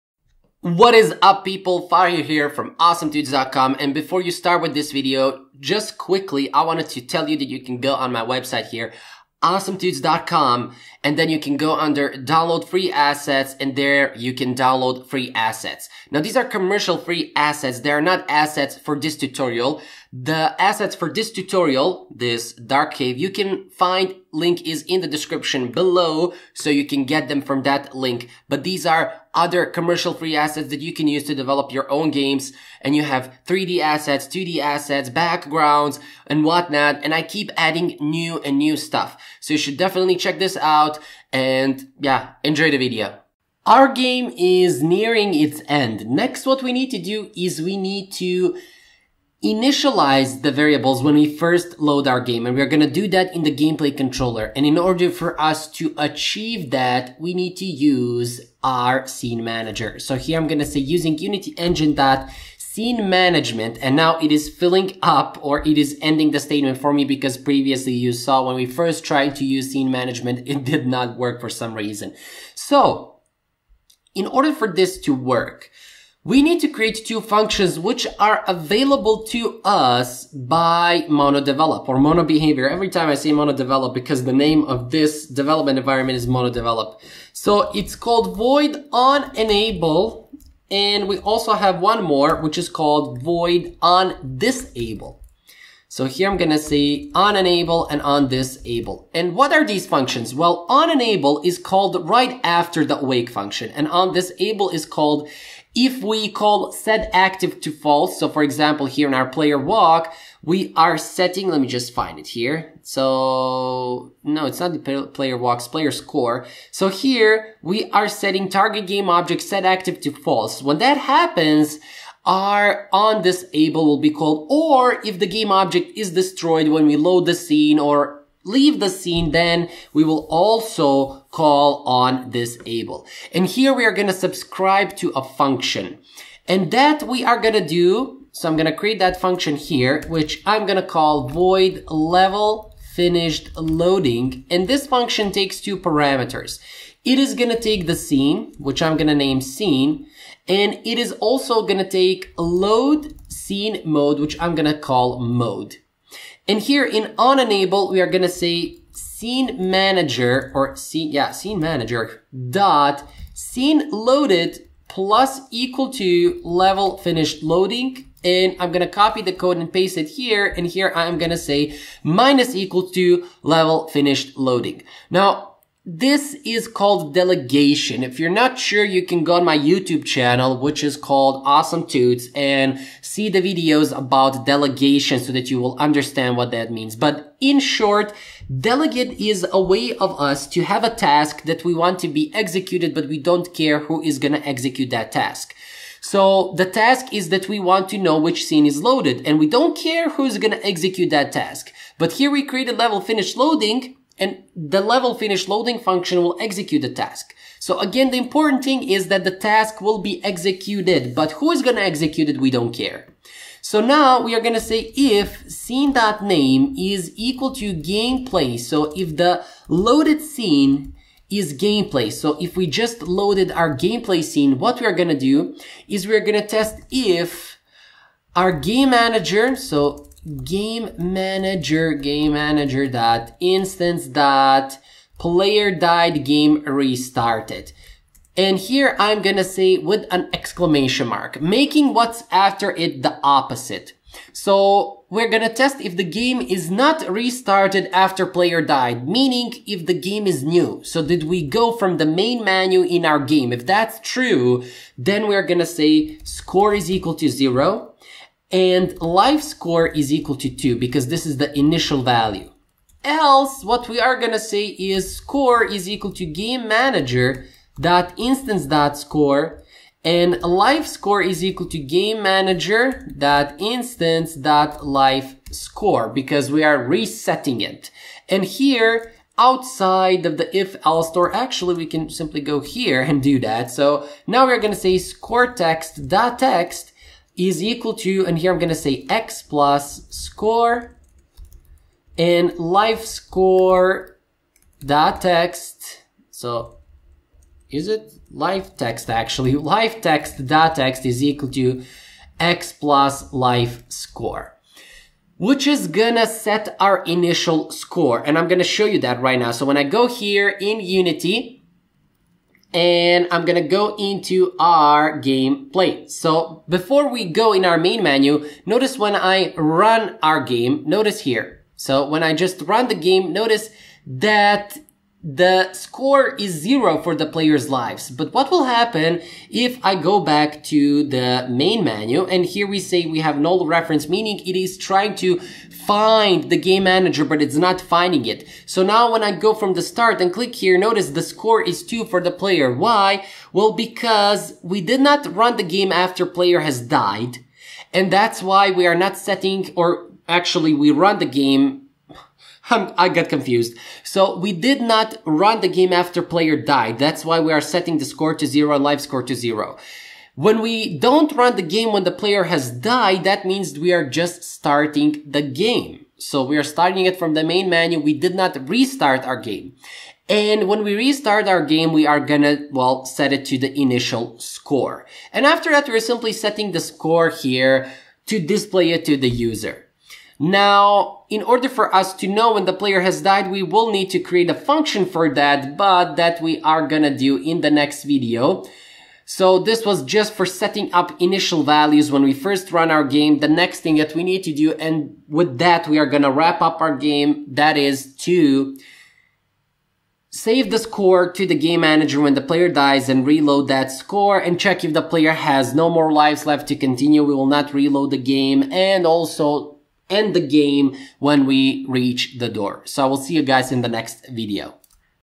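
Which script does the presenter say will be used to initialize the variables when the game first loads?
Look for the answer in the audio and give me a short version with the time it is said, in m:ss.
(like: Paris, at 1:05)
gameplay controller, at 0:53.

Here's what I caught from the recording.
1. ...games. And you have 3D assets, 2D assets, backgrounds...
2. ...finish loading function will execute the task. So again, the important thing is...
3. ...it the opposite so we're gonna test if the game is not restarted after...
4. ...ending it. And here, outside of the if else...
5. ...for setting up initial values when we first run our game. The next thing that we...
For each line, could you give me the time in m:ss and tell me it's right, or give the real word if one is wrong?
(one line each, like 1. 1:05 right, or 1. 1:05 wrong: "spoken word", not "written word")
1. 0:32 right
2. 3:25 right
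3. 4:02 right
4. 4:36 wrong: "resetting", not "ending"
5. 6:30 right.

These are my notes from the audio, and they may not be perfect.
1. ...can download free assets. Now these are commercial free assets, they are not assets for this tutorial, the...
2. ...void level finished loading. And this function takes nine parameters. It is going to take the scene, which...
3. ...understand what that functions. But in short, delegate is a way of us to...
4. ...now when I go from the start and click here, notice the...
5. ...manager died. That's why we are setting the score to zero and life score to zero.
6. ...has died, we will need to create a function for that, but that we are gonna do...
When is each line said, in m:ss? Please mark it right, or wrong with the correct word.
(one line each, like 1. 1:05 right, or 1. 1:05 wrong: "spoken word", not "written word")
1. 0:14 right
2. 2:21 wrong: "two", not "nine"
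3. 3:05 wrong: "means", not "functions"
4. 5:38 right
5. 5:56 wrong: "player", not "manager"
6. 6:23 right.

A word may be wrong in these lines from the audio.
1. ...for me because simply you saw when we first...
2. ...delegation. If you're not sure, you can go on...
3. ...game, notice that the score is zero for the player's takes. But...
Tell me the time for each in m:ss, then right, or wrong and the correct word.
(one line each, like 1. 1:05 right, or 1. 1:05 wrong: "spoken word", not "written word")
1. 1:06 wrong: "previously", not "simply"
2. 2:57 right
3. 5:22 wrong: "lives", not "takes".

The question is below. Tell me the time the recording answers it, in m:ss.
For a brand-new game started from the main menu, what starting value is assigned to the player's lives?
4:19.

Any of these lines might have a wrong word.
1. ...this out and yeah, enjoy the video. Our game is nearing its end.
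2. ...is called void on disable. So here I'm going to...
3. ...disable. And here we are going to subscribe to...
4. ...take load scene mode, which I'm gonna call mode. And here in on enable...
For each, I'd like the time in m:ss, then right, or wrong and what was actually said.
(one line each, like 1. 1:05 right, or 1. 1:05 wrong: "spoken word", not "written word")
1. 0:40 right
2. 1:32 right
3. 2:12 right
4. 2:31 right.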